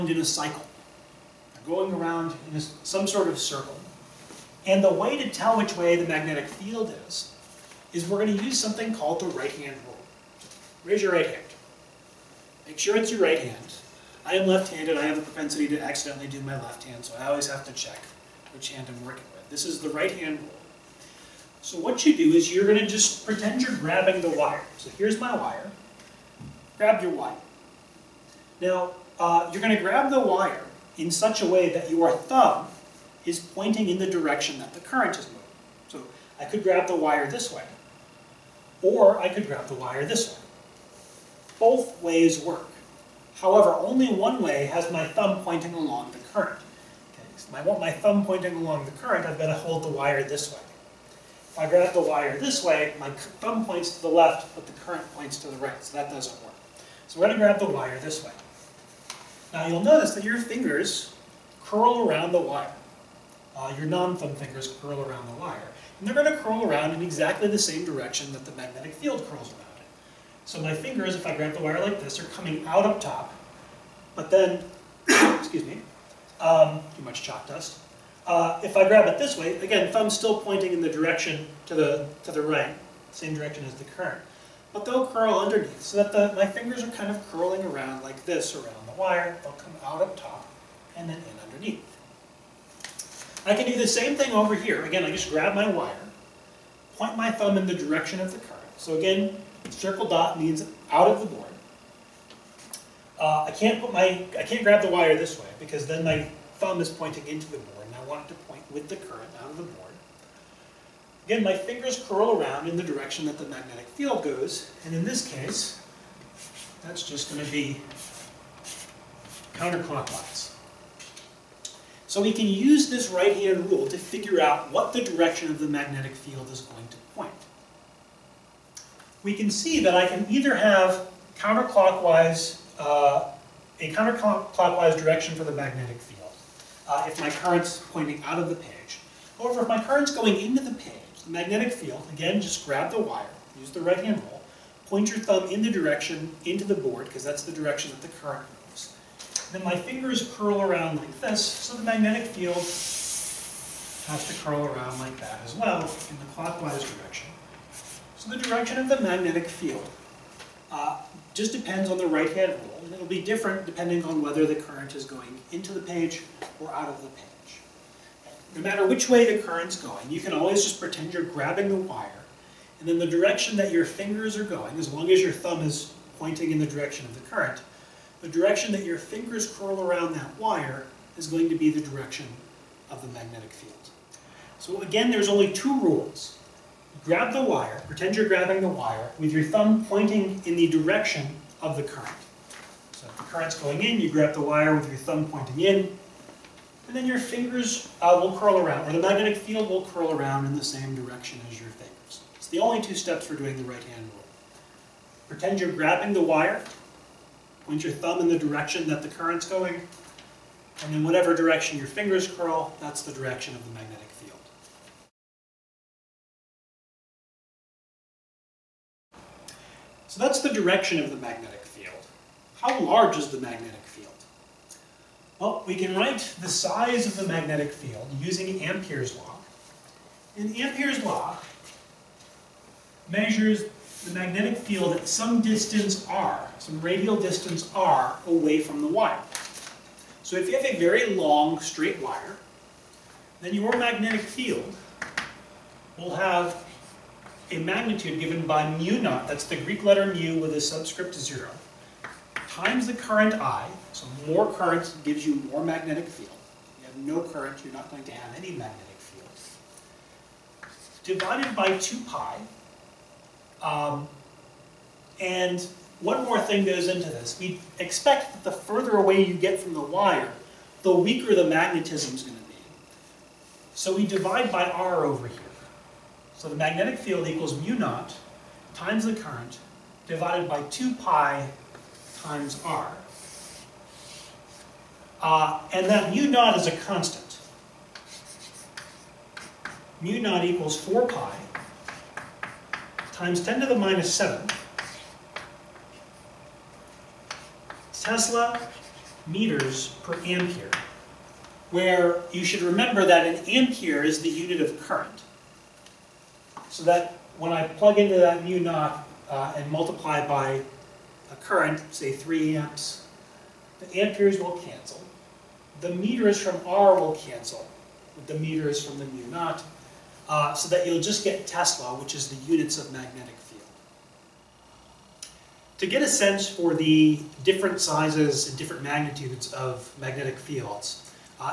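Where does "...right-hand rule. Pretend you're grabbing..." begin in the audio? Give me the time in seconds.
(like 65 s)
203 s.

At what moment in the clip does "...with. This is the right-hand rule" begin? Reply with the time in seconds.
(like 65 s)
19 s.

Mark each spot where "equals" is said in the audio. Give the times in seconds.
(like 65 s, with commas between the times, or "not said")
277 s, 290 s.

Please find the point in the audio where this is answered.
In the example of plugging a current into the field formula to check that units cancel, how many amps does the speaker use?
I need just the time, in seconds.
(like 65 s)
312 s.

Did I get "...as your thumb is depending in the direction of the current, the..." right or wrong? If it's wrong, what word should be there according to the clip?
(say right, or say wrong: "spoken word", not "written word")
wrong: "pointing", not "depending".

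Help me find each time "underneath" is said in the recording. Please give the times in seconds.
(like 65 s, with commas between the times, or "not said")
85 s, 91 s.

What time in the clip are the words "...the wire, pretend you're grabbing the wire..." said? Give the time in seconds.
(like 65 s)
187 s.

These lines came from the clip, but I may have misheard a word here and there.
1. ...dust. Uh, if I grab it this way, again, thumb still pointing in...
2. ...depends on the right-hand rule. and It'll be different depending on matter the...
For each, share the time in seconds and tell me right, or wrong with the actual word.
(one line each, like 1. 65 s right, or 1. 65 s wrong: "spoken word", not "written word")
1. 77 s right
2. 161 s wrong: "whether", not "matter".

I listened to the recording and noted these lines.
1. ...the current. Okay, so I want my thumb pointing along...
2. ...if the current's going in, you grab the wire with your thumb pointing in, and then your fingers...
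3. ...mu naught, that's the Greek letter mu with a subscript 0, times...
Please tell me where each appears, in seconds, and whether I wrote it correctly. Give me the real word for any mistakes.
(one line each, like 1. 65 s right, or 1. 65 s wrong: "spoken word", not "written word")
1. 46 s right
2. 193 s right
3. 248 s right.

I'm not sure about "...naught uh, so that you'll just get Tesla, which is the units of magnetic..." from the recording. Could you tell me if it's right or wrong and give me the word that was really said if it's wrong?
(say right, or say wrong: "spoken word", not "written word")
right.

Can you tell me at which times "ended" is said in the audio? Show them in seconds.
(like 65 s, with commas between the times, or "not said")
not said.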